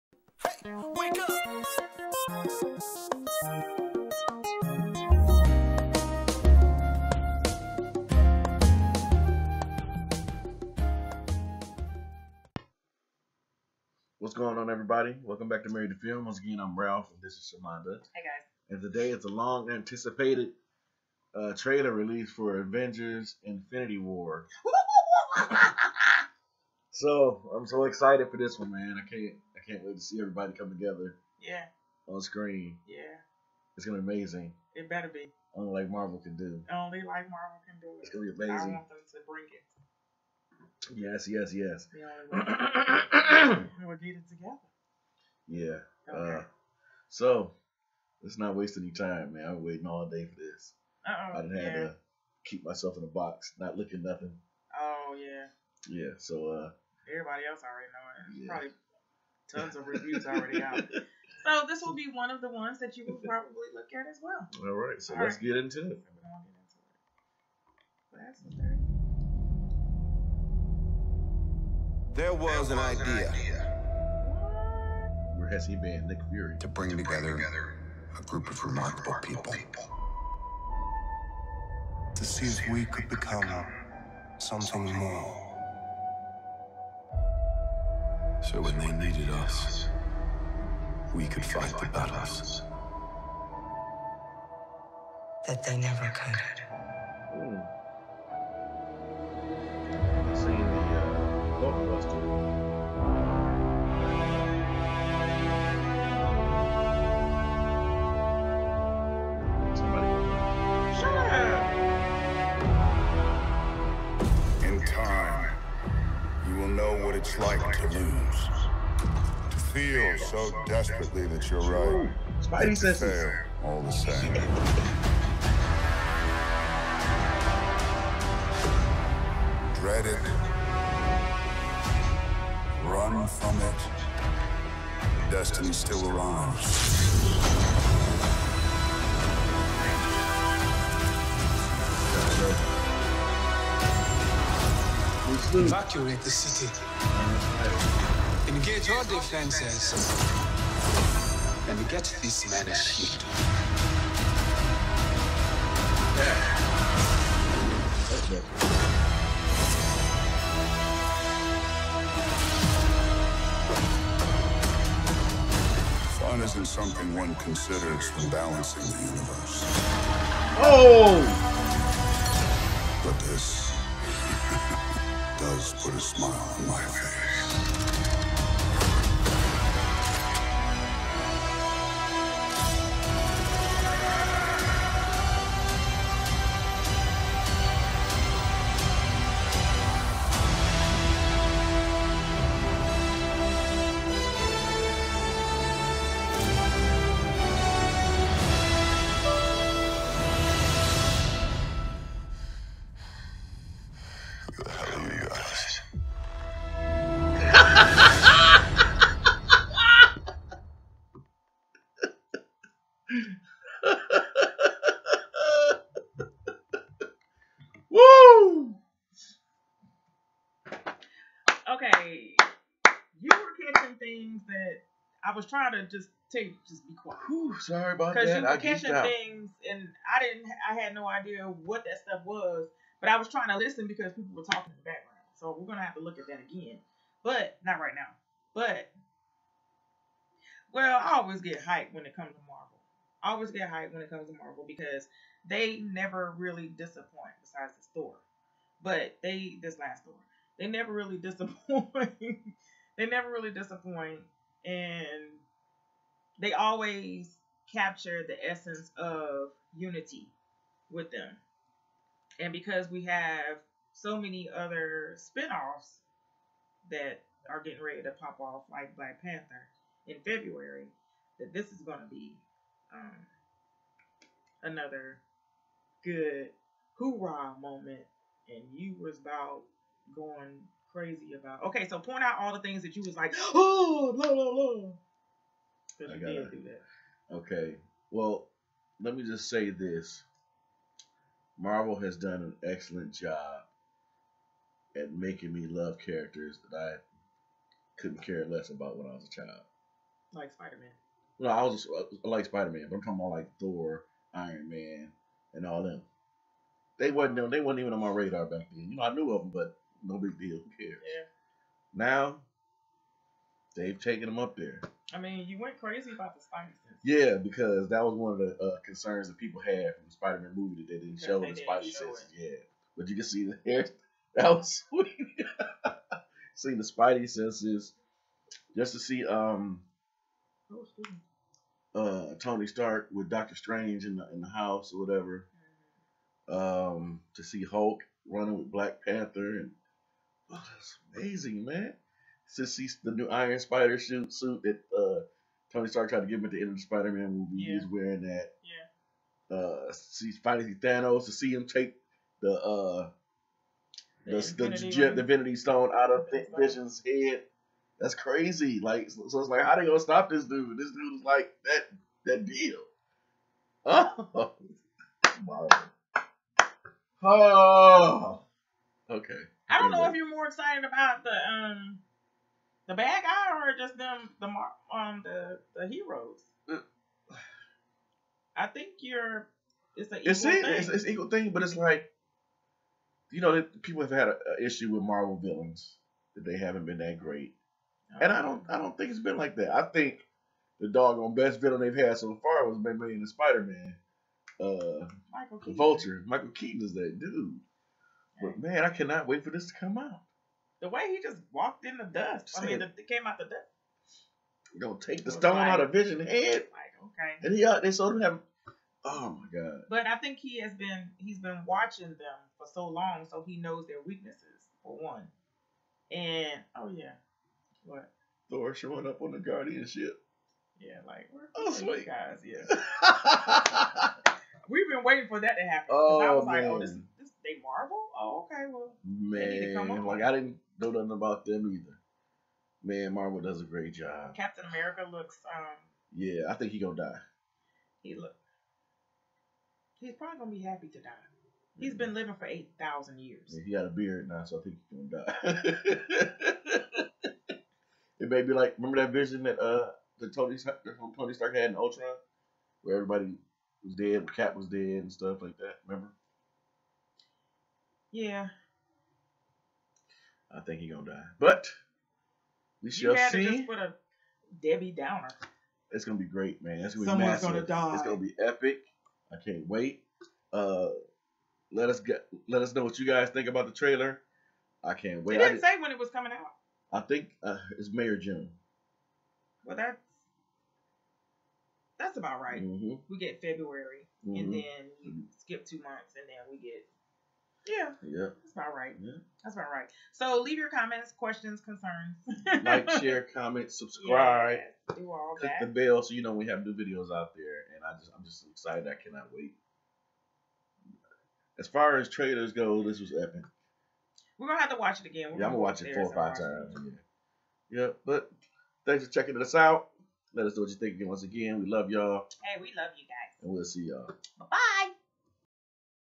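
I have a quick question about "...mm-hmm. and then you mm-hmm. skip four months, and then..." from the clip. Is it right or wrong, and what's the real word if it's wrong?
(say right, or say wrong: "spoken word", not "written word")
wrong: "two", not "four".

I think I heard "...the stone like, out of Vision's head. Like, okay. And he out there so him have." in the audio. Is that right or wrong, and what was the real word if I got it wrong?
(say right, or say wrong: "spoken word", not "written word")
right.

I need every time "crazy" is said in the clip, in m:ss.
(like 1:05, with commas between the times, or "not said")
4:40, 5:15, 5:58.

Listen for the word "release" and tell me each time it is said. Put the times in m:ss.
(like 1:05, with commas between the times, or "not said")
0:21.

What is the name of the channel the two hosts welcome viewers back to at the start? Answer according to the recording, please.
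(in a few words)
Married to Film.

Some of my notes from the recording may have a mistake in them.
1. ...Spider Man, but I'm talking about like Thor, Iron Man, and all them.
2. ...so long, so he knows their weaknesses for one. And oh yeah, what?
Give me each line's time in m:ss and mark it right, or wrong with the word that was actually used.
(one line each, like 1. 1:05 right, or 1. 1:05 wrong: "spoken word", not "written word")
1. 5:02 right
2. 6:52 right.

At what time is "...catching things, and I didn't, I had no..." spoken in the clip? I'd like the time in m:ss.
3:48.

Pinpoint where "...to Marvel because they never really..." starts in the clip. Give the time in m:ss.
4:04.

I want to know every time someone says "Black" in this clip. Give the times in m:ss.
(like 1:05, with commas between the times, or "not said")
4:28, 5:38.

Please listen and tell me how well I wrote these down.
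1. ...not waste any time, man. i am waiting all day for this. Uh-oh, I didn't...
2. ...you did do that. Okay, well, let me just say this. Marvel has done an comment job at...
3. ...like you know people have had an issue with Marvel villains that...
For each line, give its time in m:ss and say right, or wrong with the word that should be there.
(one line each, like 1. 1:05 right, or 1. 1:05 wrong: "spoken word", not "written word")
1. 0:48 right
2. 4:46 wrong: "excellent", not "comment"
3. 6:21 right.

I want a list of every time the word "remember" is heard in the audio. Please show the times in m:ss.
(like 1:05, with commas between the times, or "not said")
7:28, 7:35.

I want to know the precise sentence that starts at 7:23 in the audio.
Yeah, he got a beard now, so I think he's gonna die.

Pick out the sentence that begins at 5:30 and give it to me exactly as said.
Oh, uh, Tony Stark with Doctor Strange in the in the house or whatever.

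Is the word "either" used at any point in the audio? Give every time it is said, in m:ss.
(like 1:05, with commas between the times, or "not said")
7:11.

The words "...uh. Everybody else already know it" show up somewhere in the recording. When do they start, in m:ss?
0:56.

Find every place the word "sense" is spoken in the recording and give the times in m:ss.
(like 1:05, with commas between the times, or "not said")
5:16, 5:21, 5:27.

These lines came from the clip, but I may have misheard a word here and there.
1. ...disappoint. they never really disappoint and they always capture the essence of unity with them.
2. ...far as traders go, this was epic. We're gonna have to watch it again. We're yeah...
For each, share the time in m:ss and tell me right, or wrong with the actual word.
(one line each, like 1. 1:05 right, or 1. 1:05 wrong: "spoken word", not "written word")
1. 4:11 right
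2. 8:21 right.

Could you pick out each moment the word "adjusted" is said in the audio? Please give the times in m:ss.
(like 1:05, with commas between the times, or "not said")
not said.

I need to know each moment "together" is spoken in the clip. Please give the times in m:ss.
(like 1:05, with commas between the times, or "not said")
0:30, 0:44, 1:16.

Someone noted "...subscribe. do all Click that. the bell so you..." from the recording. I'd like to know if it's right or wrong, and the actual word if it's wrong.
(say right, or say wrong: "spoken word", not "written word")
right.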